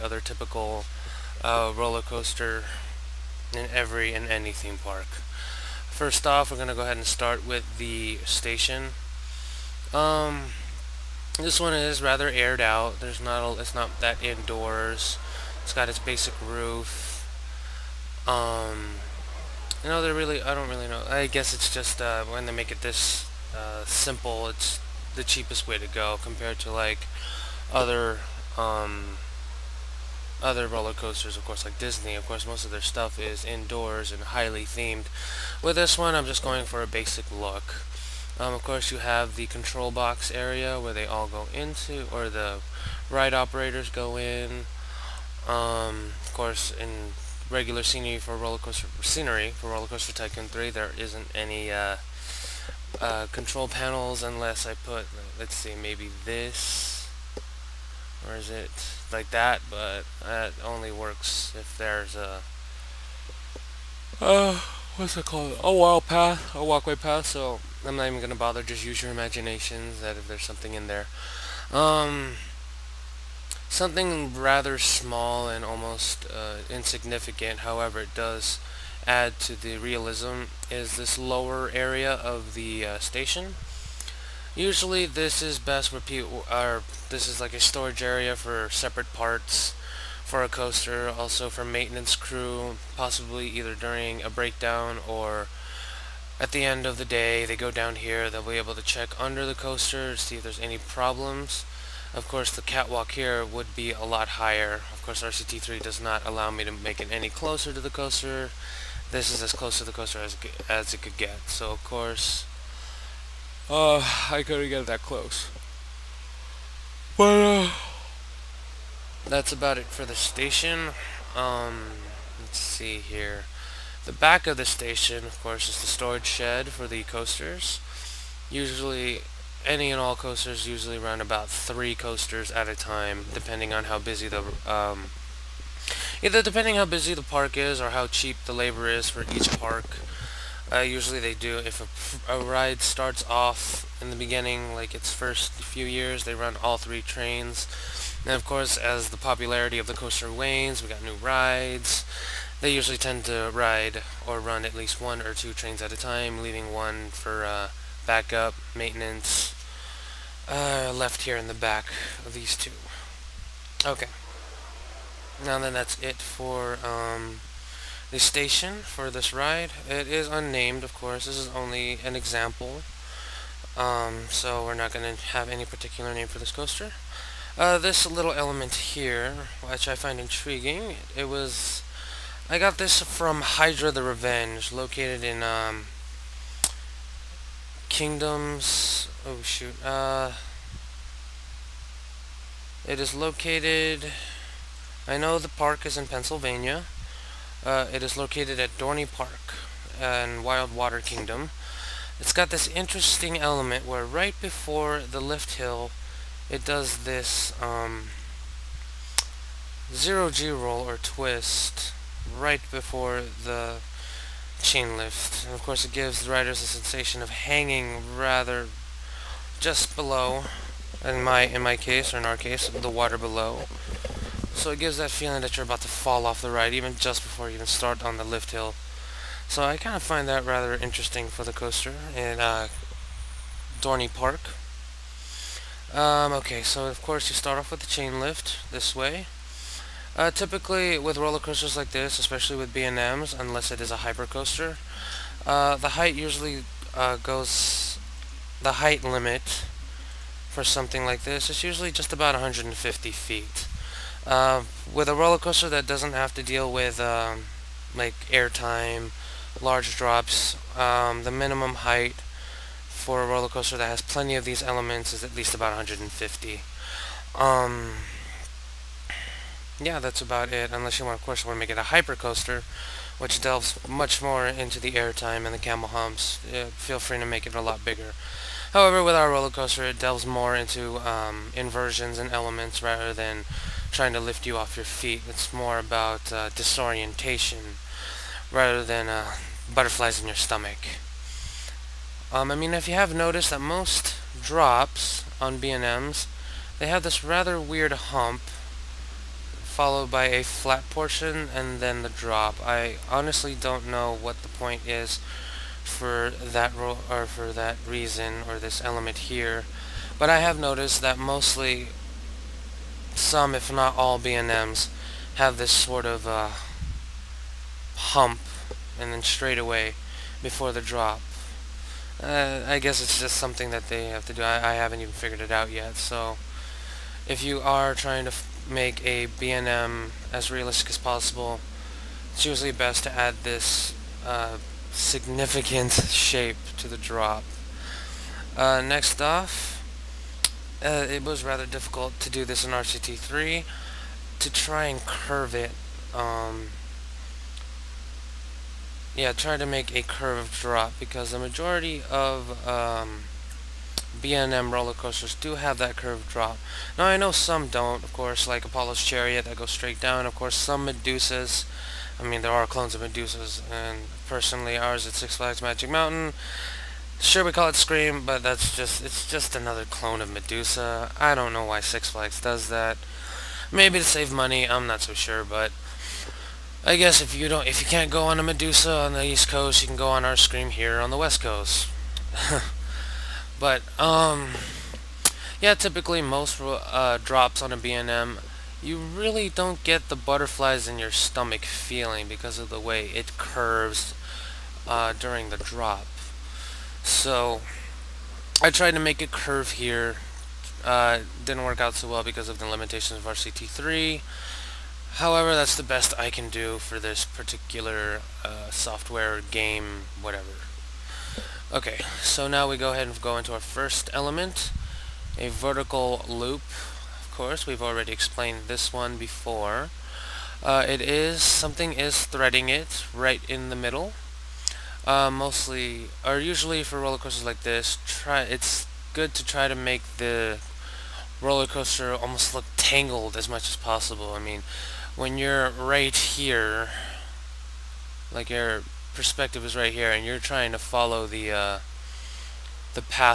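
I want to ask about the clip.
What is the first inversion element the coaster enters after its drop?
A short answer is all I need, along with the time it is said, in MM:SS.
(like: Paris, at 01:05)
vertical loop, at 06:55.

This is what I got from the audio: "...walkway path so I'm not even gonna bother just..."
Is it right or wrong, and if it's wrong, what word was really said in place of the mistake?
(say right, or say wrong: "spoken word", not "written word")
right.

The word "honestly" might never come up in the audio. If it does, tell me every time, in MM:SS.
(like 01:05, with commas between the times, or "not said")
05:03.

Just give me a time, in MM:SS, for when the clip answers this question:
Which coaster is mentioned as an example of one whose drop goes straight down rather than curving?
05:58.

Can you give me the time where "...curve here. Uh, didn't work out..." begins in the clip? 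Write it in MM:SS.
06:39.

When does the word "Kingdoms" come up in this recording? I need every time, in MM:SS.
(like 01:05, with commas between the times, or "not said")
03:07, 03:20.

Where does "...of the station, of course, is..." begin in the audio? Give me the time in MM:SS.
02:04.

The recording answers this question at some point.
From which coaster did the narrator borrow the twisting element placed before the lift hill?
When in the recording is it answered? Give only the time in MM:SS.
03:03.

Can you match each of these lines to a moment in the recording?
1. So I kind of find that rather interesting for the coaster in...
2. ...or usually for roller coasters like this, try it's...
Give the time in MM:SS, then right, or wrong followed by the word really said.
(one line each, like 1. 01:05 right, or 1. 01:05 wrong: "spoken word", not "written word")
1. 03:49 right
2. 07:06 right.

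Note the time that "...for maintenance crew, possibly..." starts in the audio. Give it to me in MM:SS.
01:31.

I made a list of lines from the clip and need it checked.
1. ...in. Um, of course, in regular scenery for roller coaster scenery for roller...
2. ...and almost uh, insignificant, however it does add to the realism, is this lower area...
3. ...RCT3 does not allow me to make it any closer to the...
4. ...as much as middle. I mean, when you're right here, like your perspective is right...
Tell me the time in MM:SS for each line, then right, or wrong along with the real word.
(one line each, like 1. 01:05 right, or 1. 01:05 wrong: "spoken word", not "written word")
1. 00:44 right
2. 01:15 right
3. 01:45 right
4. 07:13 wrong: "possible", not "middle".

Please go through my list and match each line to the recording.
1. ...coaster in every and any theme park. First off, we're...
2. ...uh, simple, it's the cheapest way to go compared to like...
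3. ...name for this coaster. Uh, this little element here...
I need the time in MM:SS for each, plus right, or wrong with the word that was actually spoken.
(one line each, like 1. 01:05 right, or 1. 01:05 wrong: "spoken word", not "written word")
1. 00:02 right
2. 00:23 right
3. 02:56 right.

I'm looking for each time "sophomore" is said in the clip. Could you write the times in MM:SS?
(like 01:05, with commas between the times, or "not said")
not said.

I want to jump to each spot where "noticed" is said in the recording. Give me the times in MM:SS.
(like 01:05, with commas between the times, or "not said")
04:53, 05:10.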